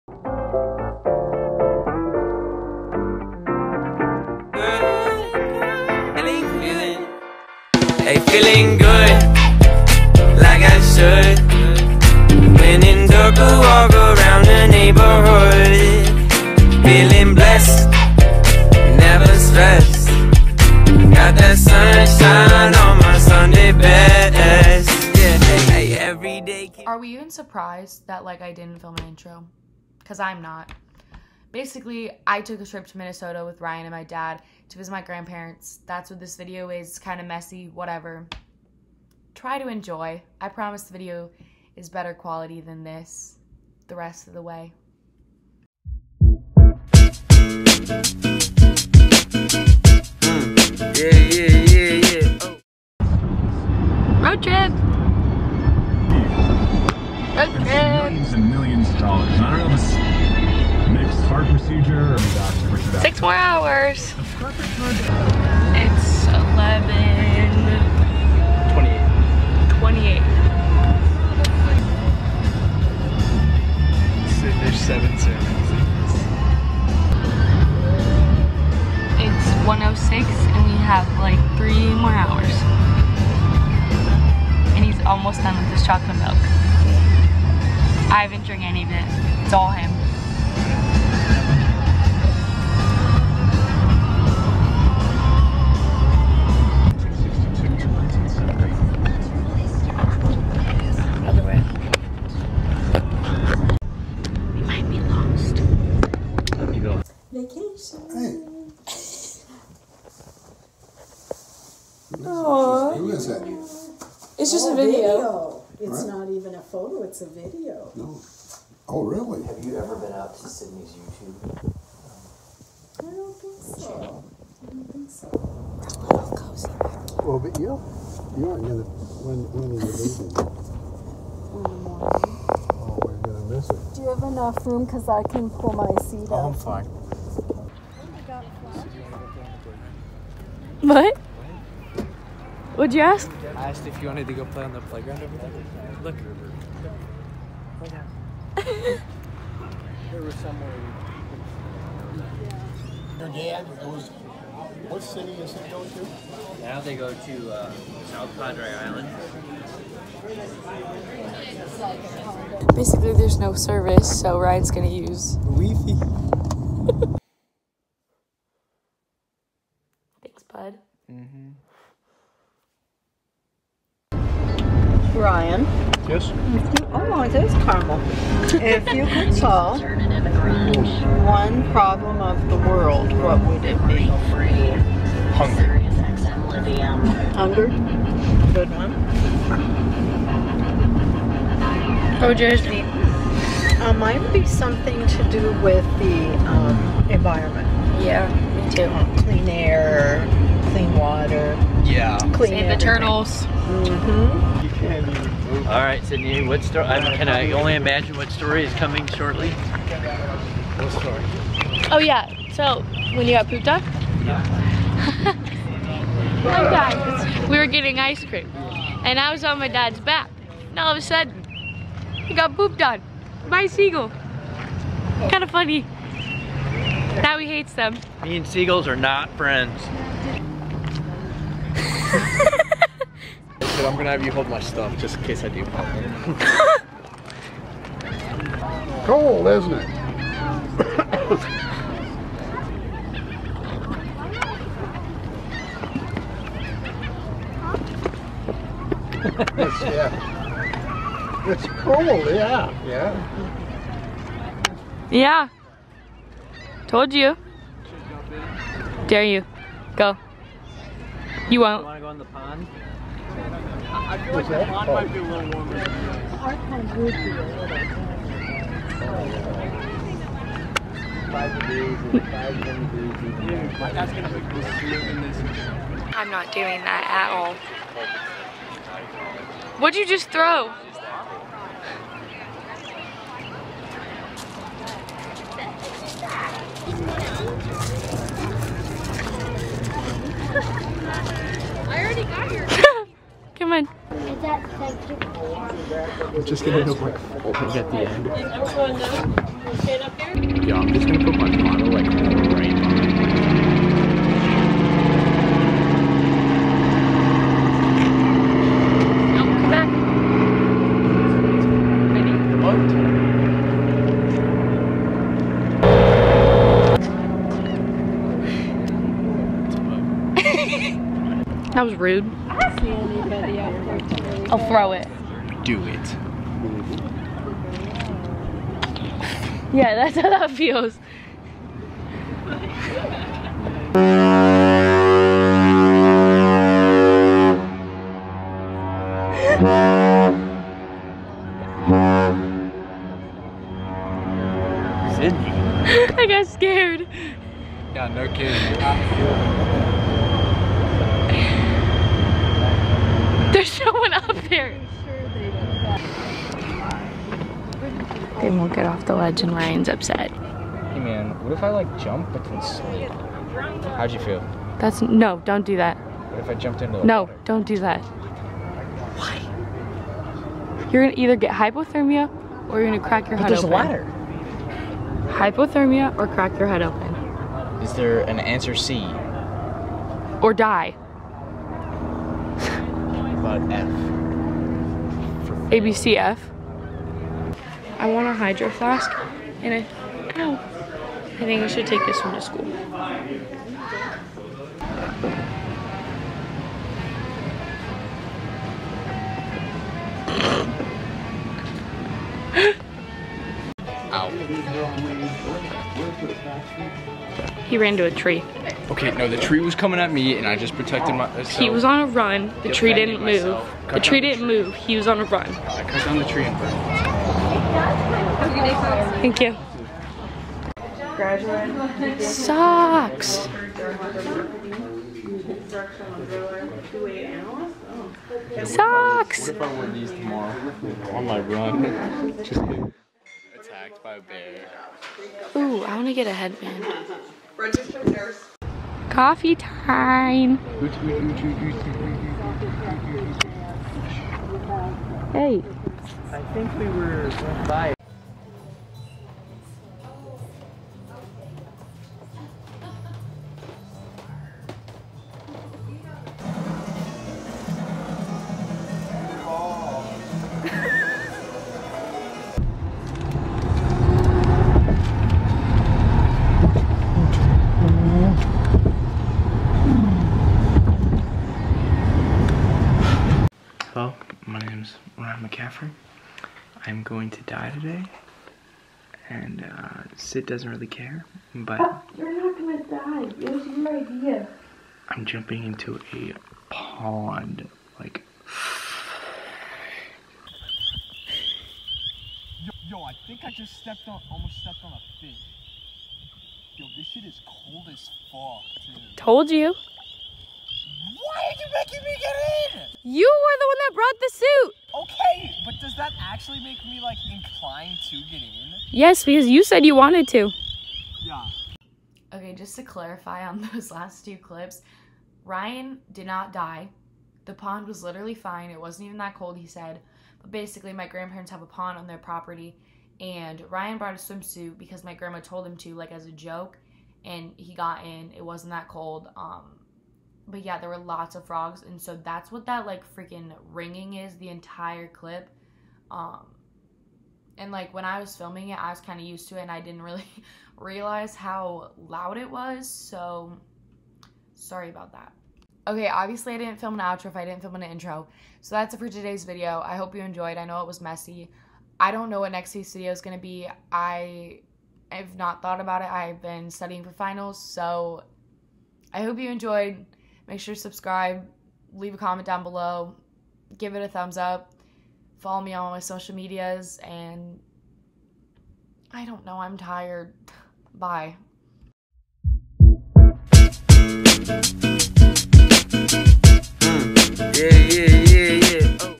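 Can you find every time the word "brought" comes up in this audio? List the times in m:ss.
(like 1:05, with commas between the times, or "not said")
8:23, 8:43.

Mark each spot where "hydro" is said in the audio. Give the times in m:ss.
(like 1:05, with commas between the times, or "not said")
6:28.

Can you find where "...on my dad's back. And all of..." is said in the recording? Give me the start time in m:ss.
3:39.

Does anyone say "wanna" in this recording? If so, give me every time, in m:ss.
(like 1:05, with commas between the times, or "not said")
4:21.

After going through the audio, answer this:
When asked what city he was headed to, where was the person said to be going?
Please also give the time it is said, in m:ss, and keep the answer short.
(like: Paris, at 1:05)
South Padre Island, at 2:38.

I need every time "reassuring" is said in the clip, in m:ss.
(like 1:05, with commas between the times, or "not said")
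not said.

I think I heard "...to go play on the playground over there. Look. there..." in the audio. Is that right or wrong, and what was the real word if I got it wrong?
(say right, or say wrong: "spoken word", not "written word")
right.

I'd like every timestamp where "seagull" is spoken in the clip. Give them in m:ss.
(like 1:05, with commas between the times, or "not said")
3:43, 3:48.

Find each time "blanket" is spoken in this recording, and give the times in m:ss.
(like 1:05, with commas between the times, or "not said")
not said.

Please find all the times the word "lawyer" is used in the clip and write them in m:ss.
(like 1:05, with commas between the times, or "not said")
not said.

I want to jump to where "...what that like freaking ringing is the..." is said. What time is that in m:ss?
8:52.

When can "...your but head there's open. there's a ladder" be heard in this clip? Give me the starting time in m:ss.
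6:13.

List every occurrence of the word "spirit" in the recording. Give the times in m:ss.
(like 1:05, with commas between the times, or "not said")
not said.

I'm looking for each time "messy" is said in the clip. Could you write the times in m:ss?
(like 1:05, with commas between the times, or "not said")
0:37, 9:11.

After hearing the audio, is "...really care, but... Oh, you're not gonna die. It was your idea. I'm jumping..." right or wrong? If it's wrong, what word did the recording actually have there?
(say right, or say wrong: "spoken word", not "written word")
right.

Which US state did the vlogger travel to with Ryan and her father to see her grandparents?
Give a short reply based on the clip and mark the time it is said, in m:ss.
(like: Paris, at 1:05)
Minnesota, at 0:32.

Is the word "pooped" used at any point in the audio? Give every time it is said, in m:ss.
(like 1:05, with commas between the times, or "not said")
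3:33, 3:42.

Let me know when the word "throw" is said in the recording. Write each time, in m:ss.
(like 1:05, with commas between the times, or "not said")
4:40, 5:24.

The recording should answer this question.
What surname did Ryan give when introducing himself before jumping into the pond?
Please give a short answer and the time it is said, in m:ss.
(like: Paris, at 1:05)
McCaffrey, at 7:55.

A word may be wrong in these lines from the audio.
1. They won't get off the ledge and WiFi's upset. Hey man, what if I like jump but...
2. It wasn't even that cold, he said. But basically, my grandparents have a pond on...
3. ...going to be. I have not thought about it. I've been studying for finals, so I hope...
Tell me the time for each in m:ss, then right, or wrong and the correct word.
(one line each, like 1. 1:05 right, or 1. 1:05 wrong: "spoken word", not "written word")
1. 5:58 wrong: "Ryan", not "WiFi"
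2. 8:38 right
3. 9:13 right.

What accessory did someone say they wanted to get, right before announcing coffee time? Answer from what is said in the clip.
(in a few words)
Headband.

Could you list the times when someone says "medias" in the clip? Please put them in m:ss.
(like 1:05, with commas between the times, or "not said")
9:26.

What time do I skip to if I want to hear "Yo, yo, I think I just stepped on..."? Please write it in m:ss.
8:12.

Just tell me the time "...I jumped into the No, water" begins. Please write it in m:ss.
6:06.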